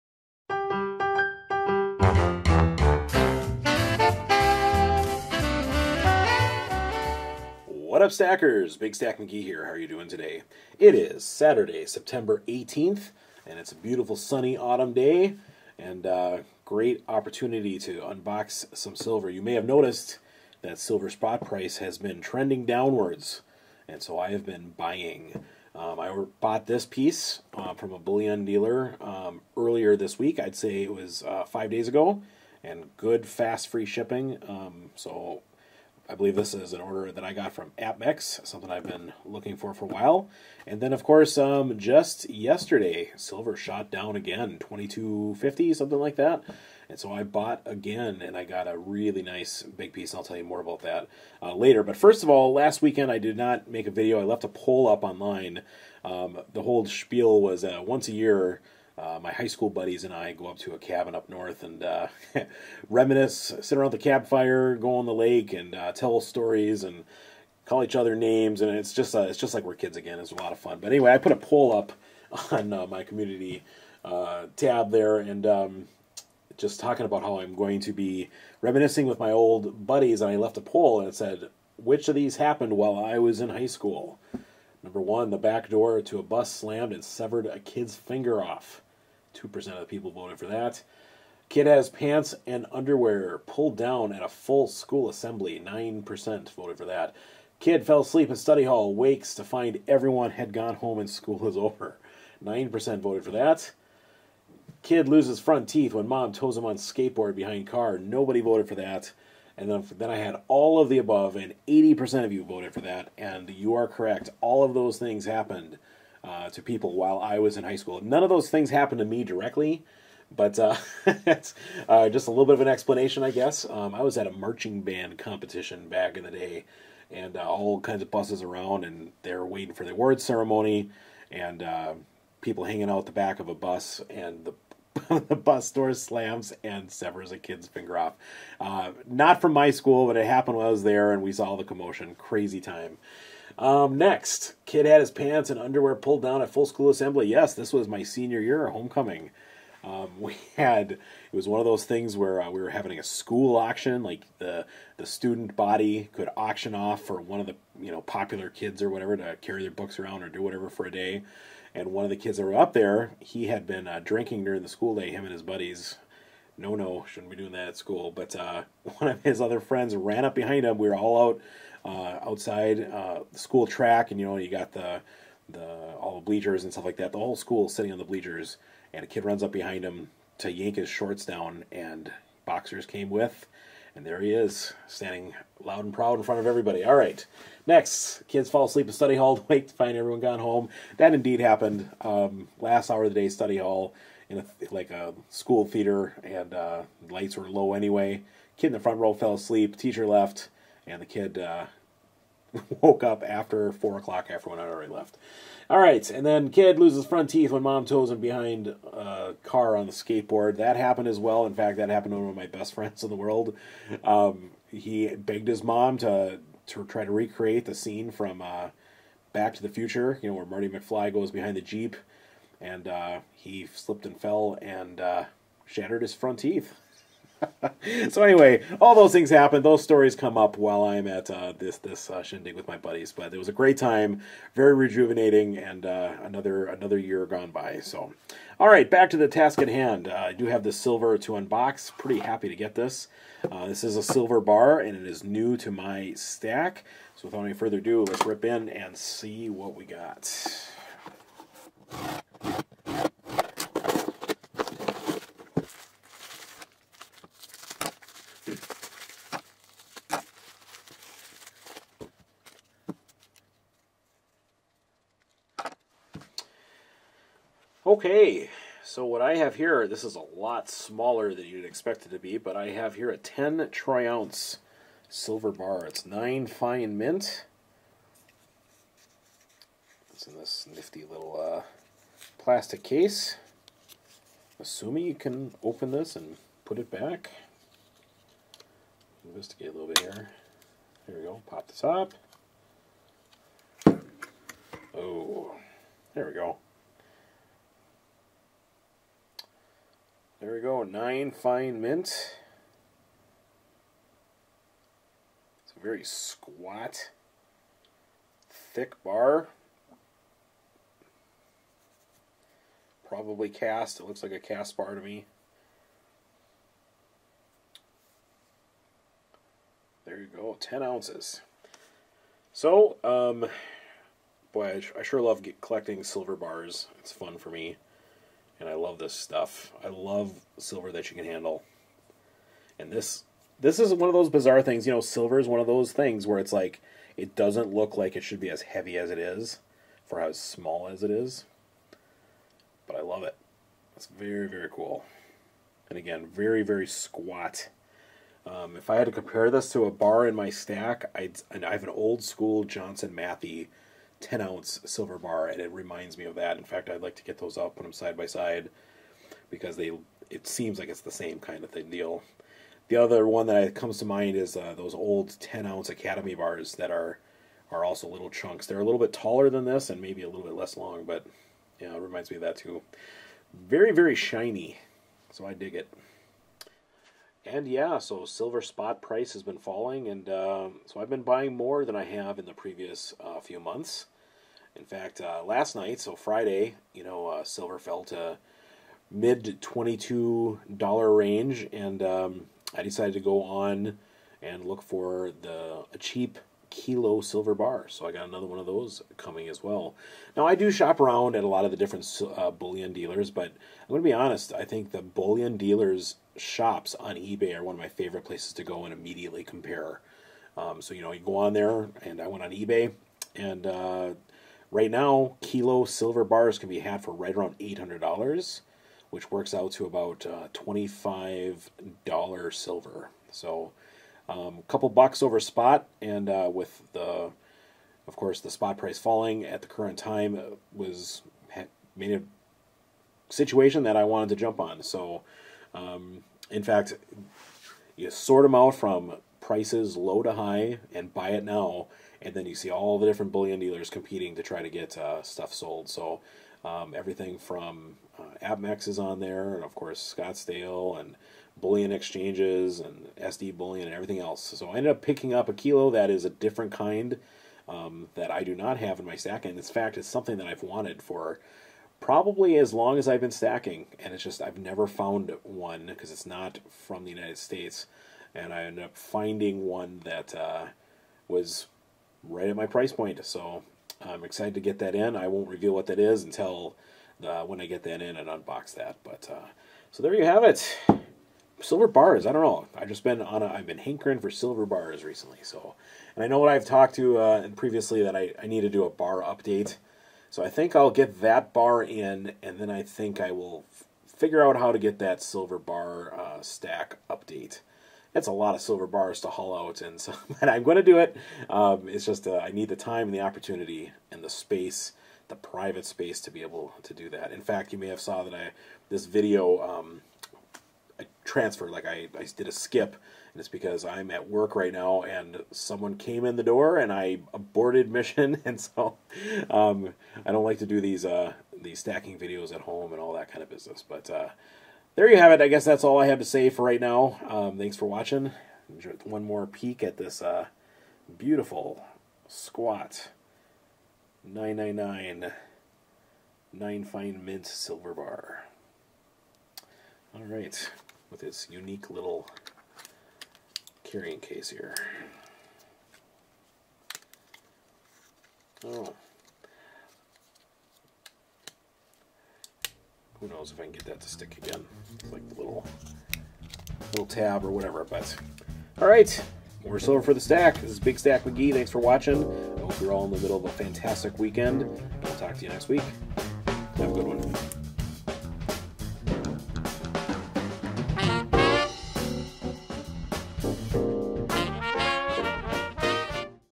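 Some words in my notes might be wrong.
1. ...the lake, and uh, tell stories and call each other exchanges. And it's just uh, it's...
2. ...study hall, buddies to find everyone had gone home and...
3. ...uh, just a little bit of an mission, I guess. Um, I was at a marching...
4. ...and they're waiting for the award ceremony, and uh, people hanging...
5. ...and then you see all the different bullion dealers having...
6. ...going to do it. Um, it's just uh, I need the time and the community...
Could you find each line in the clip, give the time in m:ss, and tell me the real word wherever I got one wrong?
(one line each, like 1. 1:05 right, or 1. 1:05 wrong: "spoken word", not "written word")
1. 1:05 wrong: "names", not "exchanges"
2. 1:38 wrong: "wakes", not "buddies"
3. 2:01 wrong: "explanation", not "mission"
4. 2:08 right
5. 7:22 wrong: "competing", not "having"
6. 8:20 wrong: "opportunity", not "community".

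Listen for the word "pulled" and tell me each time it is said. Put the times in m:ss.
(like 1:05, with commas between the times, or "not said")
1:33, 2:25.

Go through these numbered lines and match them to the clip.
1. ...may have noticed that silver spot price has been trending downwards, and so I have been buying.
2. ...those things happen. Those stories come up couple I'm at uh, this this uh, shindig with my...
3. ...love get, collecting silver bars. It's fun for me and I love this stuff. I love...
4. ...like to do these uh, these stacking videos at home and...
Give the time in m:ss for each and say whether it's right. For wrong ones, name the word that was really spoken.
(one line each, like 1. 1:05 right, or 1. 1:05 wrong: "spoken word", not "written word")
1. 0:19 right
2. 3:48 wrong: "while", not "couple"
3. 5:25 right
4. 8:40 right.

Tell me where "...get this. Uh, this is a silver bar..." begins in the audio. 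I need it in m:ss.
4:02.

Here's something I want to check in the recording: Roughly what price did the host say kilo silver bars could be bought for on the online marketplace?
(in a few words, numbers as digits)
$800.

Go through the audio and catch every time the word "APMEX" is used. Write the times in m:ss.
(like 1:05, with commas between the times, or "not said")
0:37, 7:28.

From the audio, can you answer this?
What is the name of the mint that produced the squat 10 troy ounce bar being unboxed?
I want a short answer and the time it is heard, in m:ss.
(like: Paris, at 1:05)
9 Fine Mint, at 4:36.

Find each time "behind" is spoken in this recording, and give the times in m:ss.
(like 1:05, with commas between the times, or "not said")
1:47, 2:50, 2:59, 3:28, 3:41.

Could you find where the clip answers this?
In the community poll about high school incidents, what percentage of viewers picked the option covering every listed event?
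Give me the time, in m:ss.
1:51.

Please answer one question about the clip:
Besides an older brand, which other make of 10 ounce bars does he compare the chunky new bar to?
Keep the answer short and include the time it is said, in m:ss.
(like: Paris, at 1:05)
Academy, at 6:05.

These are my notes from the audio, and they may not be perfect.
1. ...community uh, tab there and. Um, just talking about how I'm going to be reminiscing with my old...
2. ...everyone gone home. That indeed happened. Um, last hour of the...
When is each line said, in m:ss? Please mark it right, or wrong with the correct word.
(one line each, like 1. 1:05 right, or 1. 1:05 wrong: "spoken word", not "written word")
1. 1:13 right
2. 3:09 right.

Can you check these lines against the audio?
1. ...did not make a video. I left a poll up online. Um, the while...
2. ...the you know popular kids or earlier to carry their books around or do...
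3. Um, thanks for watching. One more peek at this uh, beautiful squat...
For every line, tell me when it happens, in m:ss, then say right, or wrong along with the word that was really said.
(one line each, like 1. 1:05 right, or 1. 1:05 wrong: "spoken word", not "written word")
1. 0:53 wrong: "whole", not "while"
2. 2:37 wrong: "whatever", not "earlier"
3. 8:47 right.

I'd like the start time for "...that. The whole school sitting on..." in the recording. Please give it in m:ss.
2:56.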